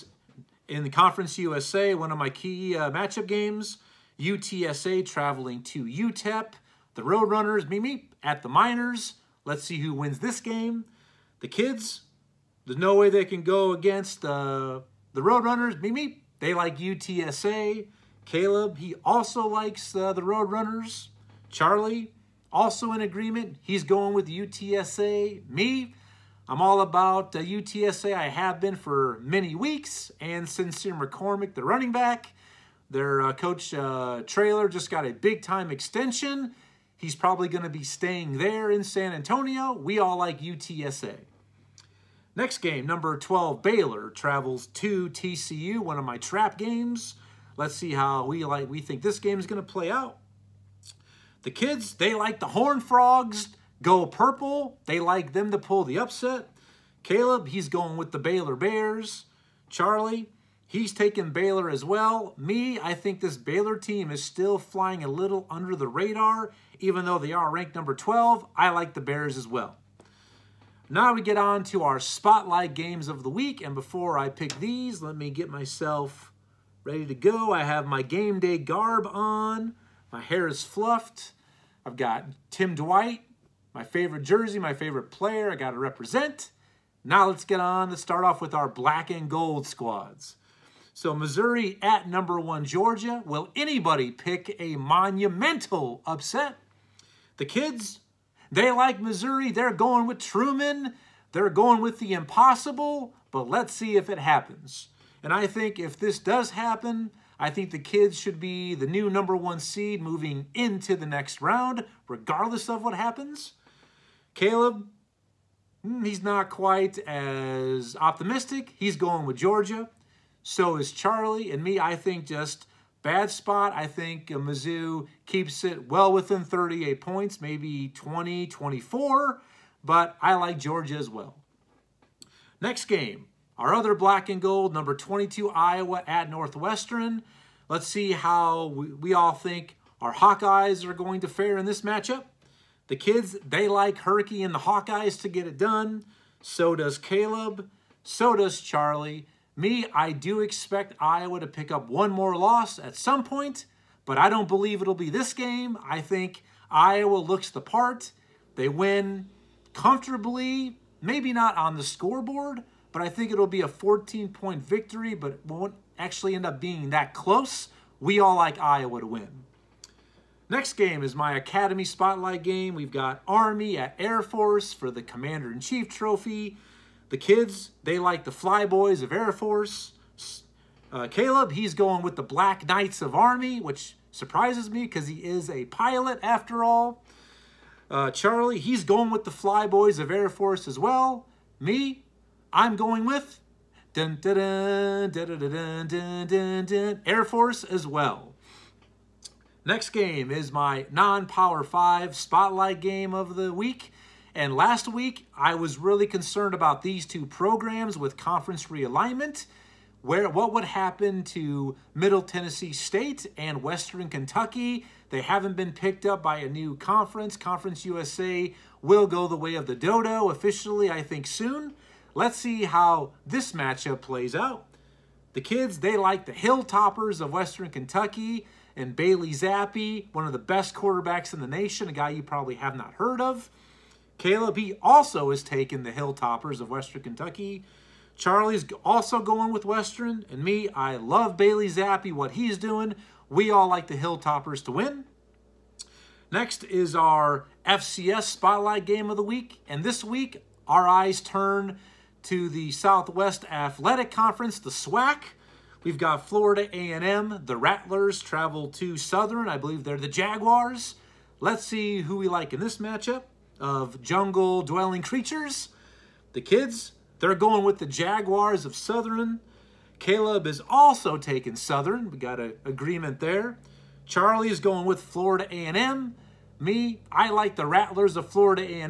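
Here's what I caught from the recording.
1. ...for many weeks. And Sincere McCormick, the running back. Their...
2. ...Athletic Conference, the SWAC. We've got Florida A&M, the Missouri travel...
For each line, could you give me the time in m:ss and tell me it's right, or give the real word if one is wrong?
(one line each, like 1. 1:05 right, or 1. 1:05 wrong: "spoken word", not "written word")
1. 0:28 right
2. 4:13 wrong: "Rattlers", not "Missouri".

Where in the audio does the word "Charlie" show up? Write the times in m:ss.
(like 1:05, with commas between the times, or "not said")
0:21, 0:59, 2:00, 2:28, 3:08, 3:58, 4:34.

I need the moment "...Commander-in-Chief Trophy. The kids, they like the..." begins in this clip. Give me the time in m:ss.
2:55.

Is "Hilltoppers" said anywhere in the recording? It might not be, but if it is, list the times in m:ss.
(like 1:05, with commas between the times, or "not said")
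3:46, 3:55, 4:03.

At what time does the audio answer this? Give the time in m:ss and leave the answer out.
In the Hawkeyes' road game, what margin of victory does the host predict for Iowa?
2:43.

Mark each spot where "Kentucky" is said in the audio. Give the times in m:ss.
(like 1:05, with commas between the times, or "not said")
3:34, 3:47, 3:57.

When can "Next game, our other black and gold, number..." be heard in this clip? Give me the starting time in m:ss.
2:12.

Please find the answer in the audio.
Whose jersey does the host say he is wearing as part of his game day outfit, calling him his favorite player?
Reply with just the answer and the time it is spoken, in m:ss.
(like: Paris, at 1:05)
Tim Dwight, at 1:22.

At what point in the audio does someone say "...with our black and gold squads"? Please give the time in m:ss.
1:28.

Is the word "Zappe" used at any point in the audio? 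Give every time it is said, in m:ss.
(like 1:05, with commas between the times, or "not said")
3:49, 4:01.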